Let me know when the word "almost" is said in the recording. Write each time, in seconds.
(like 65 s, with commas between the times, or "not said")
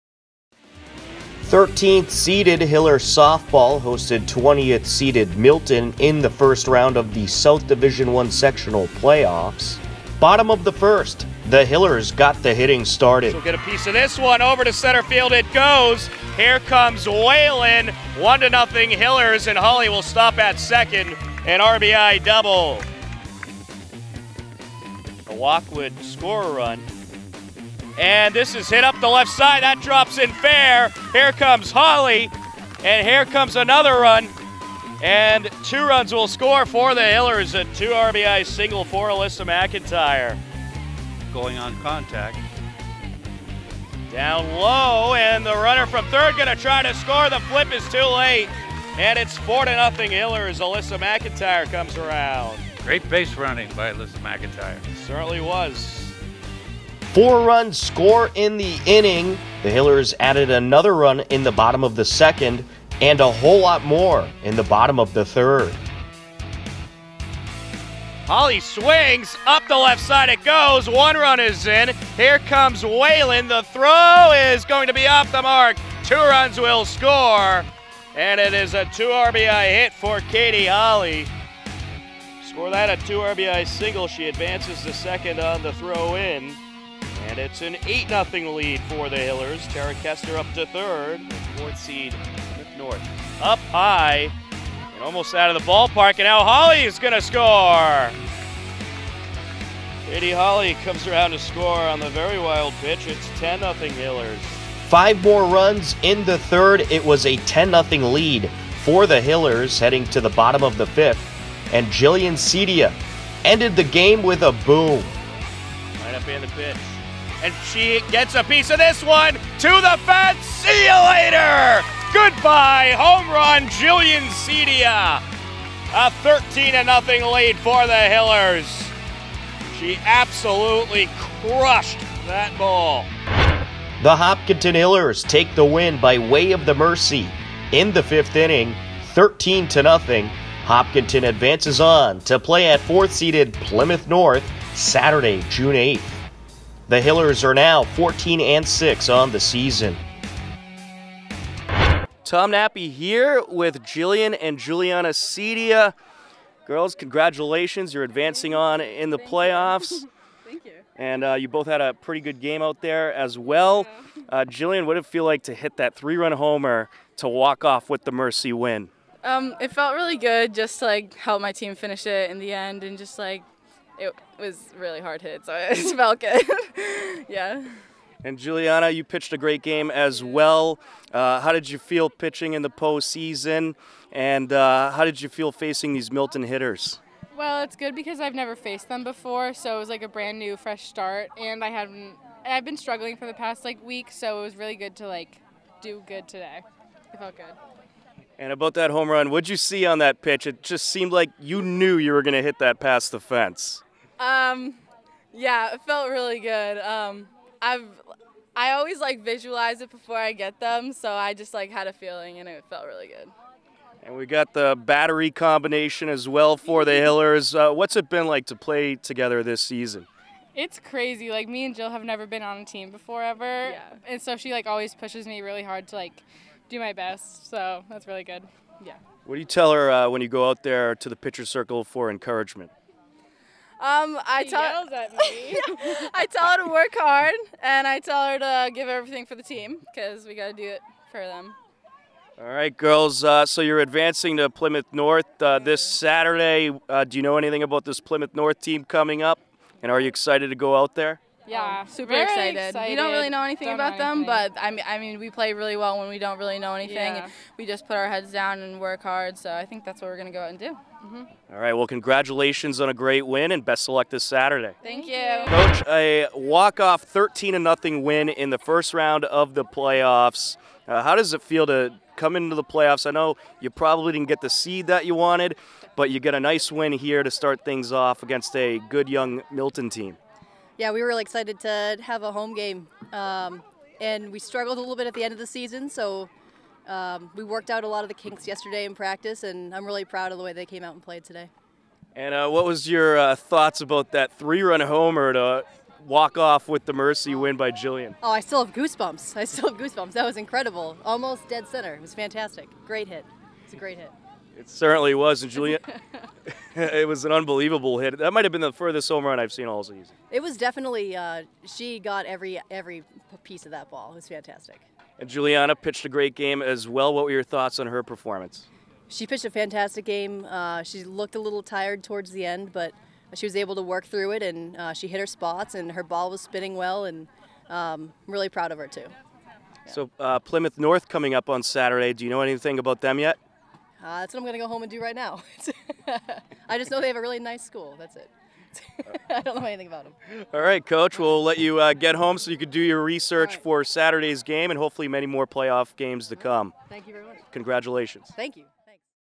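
95 s, 301 s.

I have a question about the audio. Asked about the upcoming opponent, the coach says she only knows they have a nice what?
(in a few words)
school.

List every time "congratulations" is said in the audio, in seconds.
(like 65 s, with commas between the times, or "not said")
156 s, 261 s, 347 s.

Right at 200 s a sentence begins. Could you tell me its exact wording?
It just seemed like you knew you were going to hit that past the fence.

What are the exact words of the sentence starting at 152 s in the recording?
Tom Nappy here with Jillian and Juliana Cedia.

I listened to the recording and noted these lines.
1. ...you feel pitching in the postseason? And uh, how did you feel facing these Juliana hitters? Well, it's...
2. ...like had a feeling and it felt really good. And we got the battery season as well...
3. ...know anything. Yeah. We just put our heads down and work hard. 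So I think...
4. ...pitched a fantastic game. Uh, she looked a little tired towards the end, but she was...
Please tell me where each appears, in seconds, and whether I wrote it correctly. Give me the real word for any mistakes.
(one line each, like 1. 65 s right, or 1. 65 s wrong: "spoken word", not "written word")
1. 181 s wrong: "Milton", not "Juliana"
2. 211 s wrong: "combination", not "season"
3. 256 s right
4. 319 s right.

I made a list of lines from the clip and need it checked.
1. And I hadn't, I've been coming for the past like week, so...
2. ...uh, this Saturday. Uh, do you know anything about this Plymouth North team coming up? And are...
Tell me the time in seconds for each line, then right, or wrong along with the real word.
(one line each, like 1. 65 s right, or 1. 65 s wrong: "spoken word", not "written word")
1. 191 s wrong: "struggling", not "coming"
2. 245 s right.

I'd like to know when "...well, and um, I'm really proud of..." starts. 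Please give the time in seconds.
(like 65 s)
326 s.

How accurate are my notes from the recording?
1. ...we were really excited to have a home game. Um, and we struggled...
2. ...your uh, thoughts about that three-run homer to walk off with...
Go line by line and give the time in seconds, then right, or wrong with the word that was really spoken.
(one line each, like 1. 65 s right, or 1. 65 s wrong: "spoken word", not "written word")
1. 280 s right
2. 292 s right.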